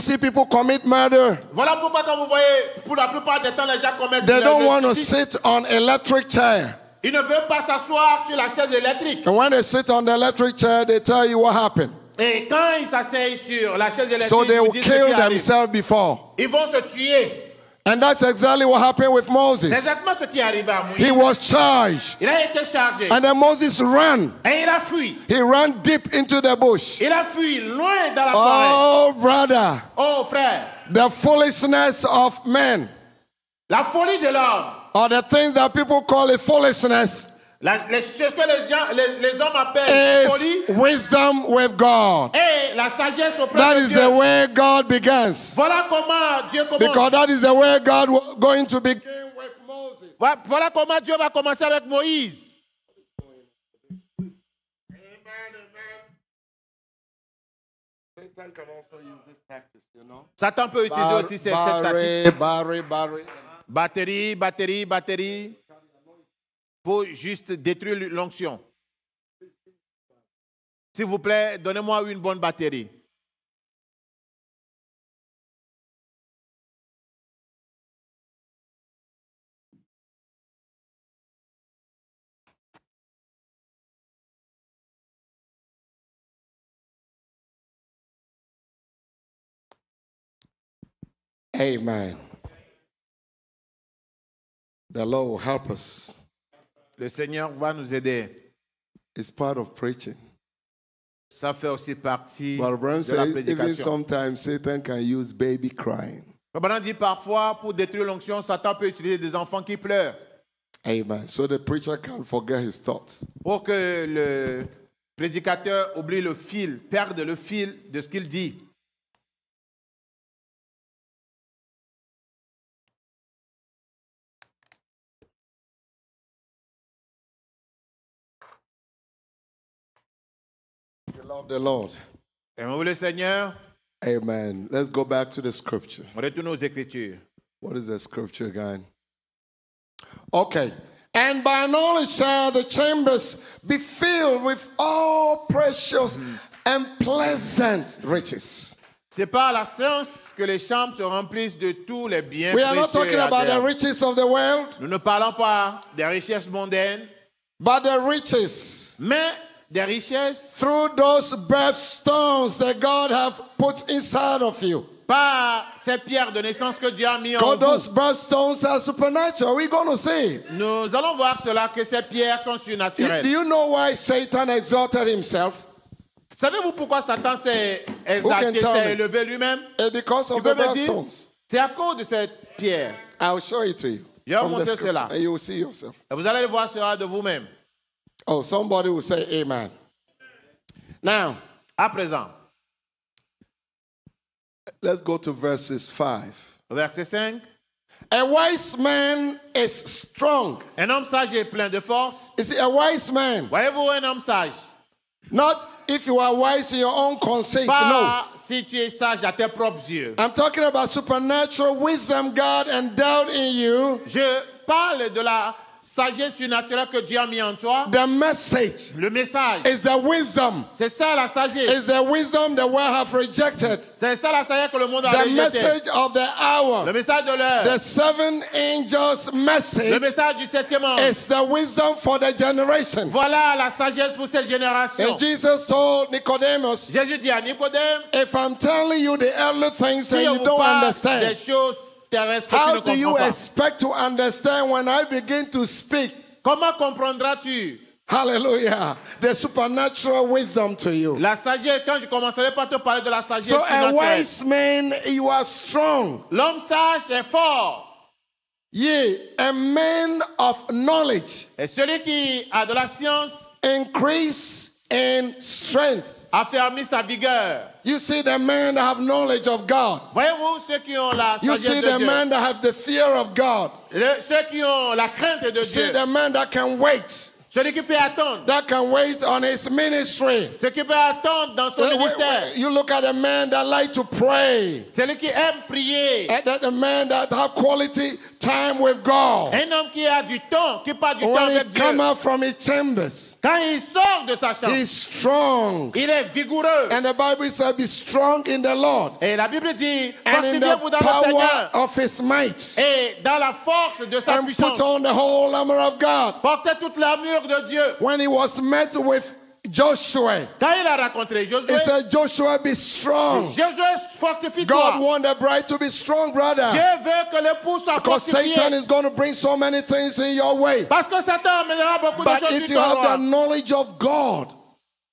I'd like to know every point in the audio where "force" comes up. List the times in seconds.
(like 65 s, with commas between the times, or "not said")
201 s, 303 s.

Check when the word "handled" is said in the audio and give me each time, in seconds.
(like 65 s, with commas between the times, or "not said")
not said.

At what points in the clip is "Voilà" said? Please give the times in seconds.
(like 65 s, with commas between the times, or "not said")
1 s, 45 s, 50 s, 233 s.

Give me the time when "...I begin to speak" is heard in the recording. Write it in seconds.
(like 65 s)
244 s.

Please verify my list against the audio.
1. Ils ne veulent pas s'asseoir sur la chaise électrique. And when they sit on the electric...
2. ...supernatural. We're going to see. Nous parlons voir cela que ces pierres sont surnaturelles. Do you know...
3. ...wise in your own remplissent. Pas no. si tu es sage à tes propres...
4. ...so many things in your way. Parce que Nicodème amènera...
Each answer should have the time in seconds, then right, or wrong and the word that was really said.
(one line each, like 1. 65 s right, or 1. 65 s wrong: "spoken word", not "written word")
1. 7 s right
2. 168 s wrong: "allons", not "parlons"
3. 206 s wrong: "consent", not "remplissent"
4. 319 s wrong: "Satan", not "Nicodème".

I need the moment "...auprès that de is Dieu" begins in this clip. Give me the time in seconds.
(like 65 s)
43 s.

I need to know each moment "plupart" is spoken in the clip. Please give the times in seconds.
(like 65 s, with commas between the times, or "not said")
3 s.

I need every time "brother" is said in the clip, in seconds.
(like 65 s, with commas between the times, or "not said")
29 s, 316 s.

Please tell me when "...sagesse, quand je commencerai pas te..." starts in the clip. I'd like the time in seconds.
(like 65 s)
251 s.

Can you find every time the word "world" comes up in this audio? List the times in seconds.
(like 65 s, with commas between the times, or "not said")
154 s, 222 s.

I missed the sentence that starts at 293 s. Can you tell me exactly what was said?
Quand il sort de sa chambre.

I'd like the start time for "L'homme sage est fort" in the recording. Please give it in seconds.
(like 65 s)
256 s.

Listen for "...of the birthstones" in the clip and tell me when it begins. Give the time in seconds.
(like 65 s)
180 s.